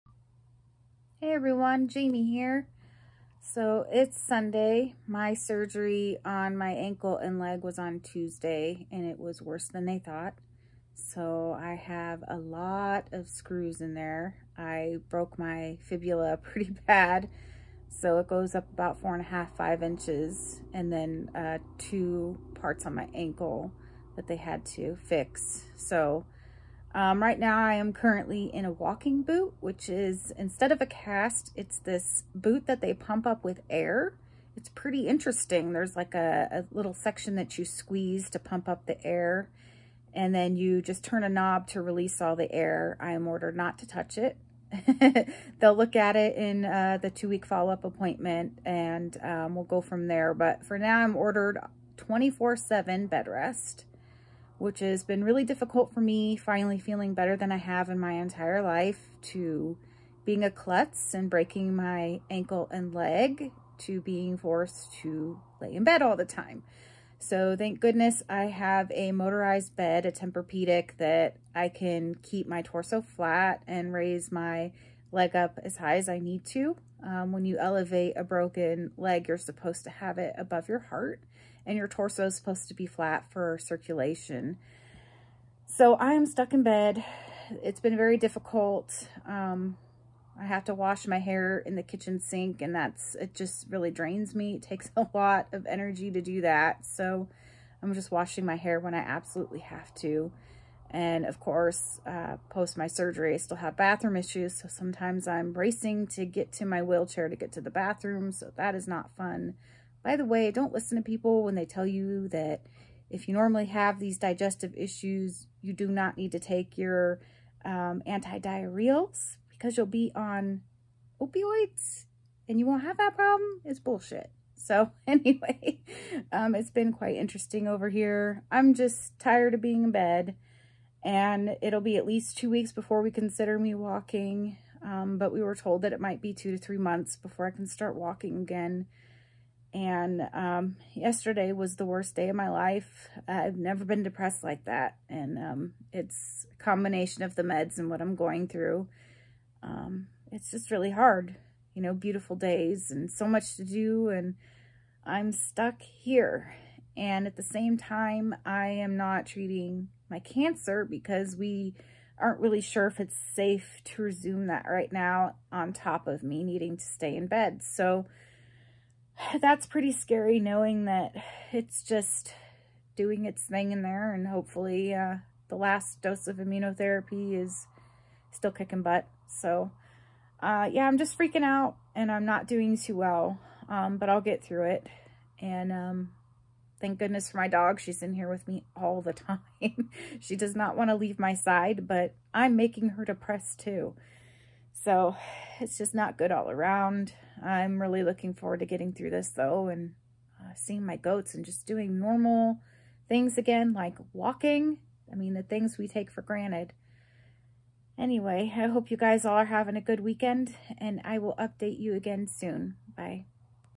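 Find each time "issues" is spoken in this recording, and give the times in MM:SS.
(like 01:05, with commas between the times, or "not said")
01:44, 01:54.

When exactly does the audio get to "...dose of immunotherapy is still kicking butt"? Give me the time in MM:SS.
02:56.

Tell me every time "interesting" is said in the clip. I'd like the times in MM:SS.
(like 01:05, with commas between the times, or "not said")
00:35, 02:07.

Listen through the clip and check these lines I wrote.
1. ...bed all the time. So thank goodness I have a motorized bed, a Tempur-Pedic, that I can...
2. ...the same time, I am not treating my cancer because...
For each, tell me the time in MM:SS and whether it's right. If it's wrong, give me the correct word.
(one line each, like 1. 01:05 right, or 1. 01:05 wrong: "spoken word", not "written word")
1. 01:05 right
2. 02:37 right.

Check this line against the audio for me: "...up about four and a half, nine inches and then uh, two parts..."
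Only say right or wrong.
wrong.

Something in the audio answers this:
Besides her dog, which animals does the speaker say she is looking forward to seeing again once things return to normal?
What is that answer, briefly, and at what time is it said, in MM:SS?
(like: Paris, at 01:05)
Goats, at 03:20.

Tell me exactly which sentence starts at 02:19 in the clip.
And um, yesterday was the worst day of my life.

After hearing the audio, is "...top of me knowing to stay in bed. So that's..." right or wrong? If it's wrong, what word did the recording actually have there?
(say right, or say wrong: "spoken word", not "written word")
wrong: "needing", not "knowing".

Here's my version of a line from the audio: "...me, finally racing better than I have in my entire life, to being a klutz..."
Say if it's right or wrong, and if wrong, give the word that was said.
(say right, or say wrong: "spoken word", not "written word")
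wrong: "feeling", not "racing".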